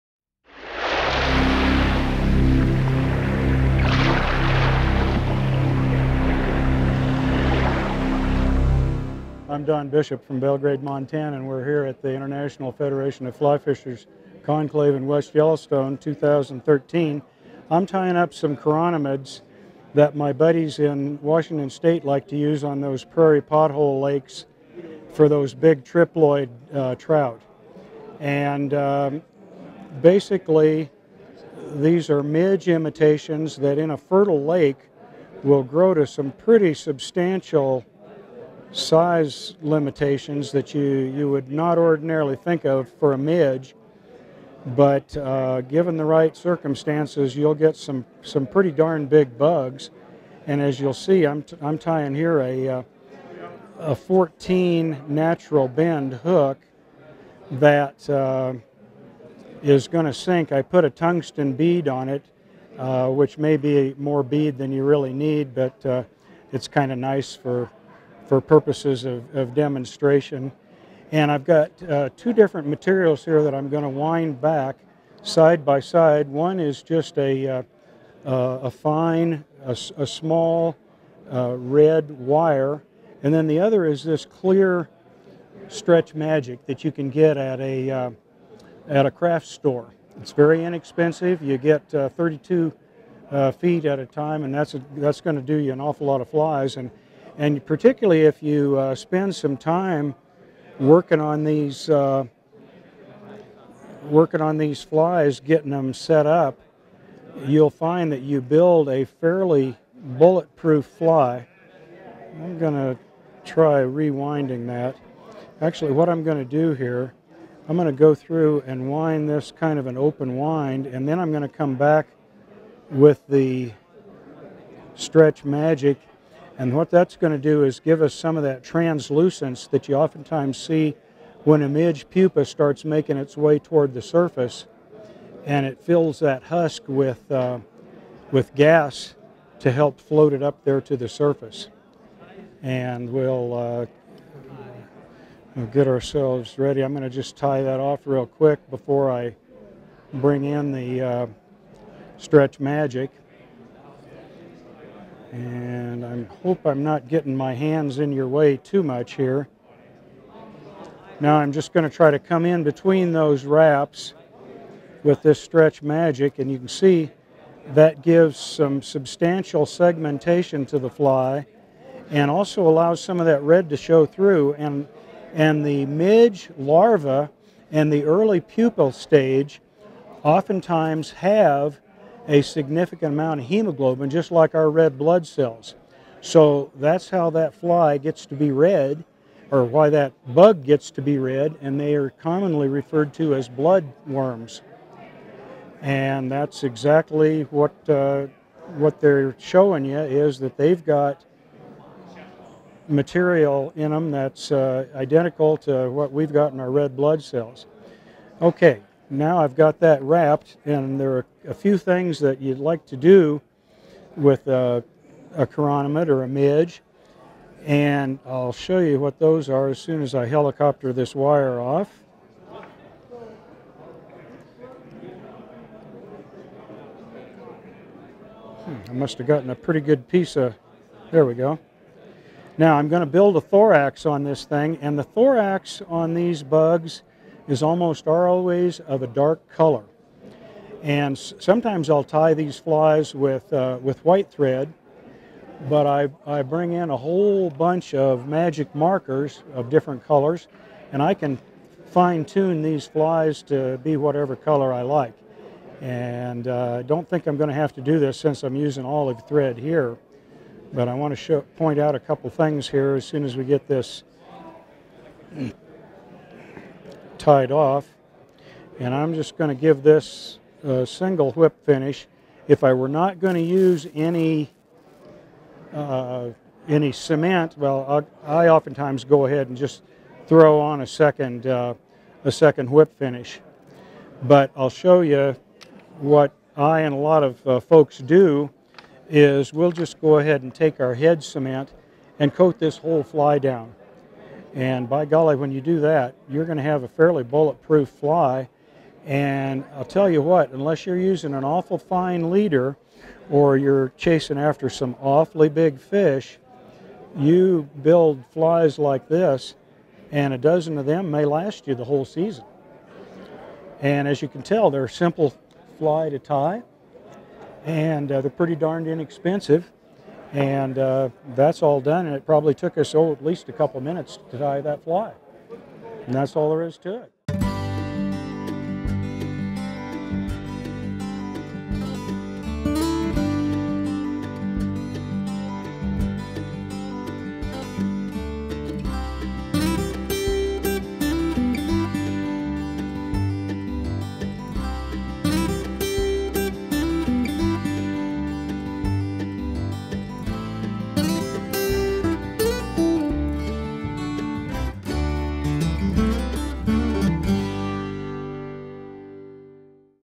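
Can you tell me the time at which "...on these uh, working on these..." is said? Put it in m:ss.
1:41.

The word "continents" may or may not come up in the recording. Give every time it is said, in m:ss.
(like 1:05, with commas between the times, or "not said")
not said.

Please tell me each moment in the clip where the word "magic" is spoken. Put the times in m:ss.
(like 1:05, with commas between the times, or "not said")
1:26, 2:05, 2:32, 2:45, 4:08.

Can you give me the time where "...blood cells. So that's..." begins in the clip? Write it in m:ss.
3:04.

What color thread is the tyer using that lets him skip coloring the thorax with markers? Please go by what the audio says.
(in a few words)
Olive.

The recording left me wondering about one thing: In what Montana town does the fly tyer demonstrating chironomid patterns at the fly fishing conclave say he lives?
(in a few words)
Belgrade.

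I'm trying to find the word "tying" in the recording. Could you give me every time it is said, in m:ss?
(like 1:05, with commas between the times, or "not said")
0:17, 0:51.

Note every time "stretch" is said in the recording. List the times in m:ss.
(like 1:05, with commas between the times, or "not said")
1:25, 2:04, 2:32, 2:45.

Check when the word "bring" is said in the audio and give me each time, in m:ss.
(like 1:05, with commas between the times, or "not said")
2:30, 4:06.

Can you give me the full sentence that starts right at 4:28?
And I'm just going to give this a uh, single whip finish.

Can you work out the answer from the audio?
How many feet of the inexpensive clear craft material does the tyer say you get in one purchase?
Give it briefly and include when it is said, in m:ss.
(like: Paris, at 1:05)
32, at 1:31.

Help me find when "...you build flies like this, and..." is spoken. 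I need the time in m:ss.
5:07.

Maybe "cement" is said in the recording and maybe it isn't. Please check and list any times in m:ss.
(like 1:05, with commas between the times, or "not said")
4:36, 4:51.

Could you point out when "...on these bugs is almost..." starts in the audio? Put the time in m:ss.
3:55.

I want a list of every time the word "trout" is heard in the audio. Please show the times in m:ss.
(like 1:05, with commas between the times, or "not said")
0:26.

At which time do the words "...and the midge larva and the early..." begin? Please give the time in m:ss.
2:55.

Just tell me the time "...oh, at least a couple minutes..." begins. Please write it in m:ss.
5:22.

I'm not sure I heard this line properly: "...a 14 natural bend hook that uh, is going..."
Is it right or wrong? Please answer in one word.
right.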